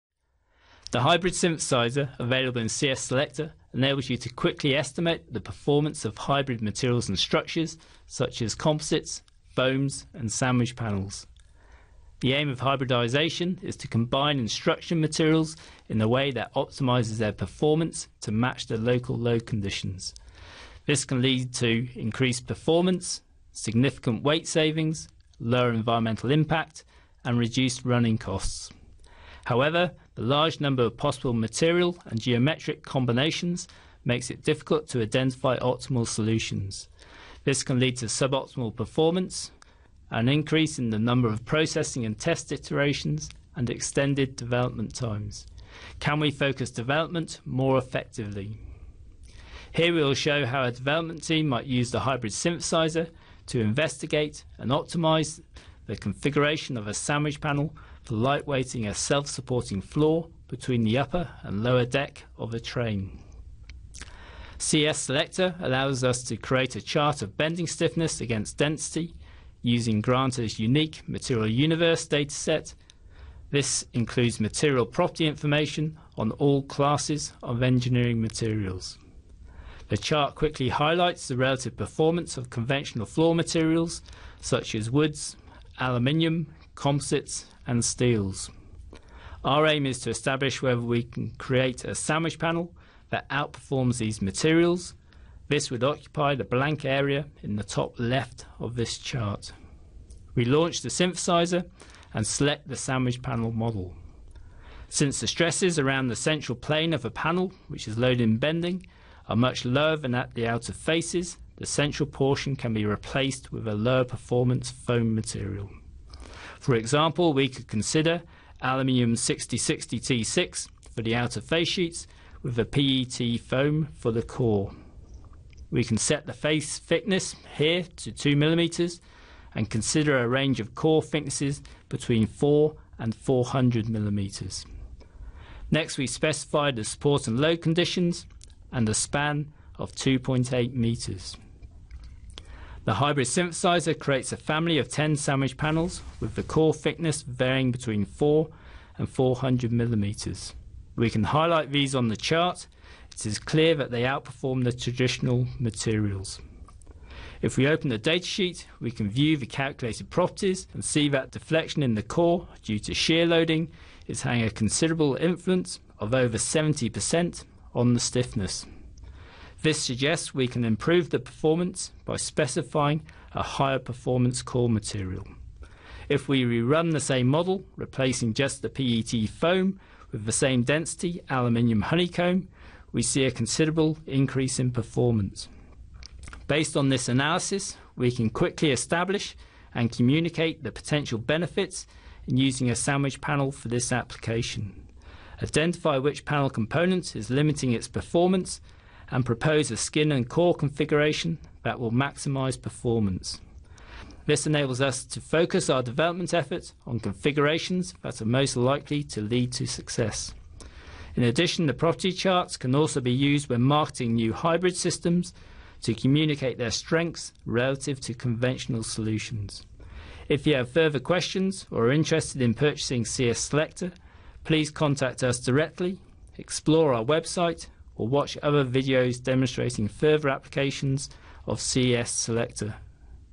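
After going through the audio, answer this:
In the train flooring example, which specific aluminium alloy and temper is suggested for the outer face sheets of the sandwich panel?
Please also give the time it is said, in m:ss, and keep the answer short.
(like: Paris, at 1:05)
6060 T6, at 1:59.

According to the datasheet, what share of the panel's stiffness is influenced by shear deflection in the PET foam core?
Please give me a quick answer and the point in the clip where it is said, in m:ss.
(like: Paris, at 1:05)
over 70%, at 2:46.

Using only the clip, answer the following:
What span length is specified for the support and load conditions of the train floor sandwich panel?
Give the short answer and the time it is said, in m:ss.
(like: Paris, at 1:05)
2.8 meters, at 2:19.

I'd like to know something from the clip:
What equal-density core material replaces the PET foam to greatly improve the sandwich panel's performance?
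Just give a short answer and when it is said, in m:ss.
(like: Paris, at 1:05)
aluminium honeycomb, at 3:01.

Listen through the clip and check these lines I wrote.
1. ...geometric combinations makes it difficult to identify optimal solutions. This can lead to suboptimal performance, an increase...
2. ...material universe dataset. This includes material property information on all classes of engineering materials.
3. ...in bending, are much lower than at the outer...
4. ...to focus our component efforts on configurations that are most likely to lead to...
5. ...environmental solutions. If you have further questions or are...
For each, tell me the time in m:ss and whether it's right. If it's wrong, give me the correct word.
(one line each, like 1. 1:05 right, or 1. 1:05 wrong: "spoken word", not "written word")
1. 0:32 right
2. 1:11 right
3. 1:48 right
4. 3:25 wrong: "development", not "component"
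5. 3:38 wrong: "conventional", not "environmental".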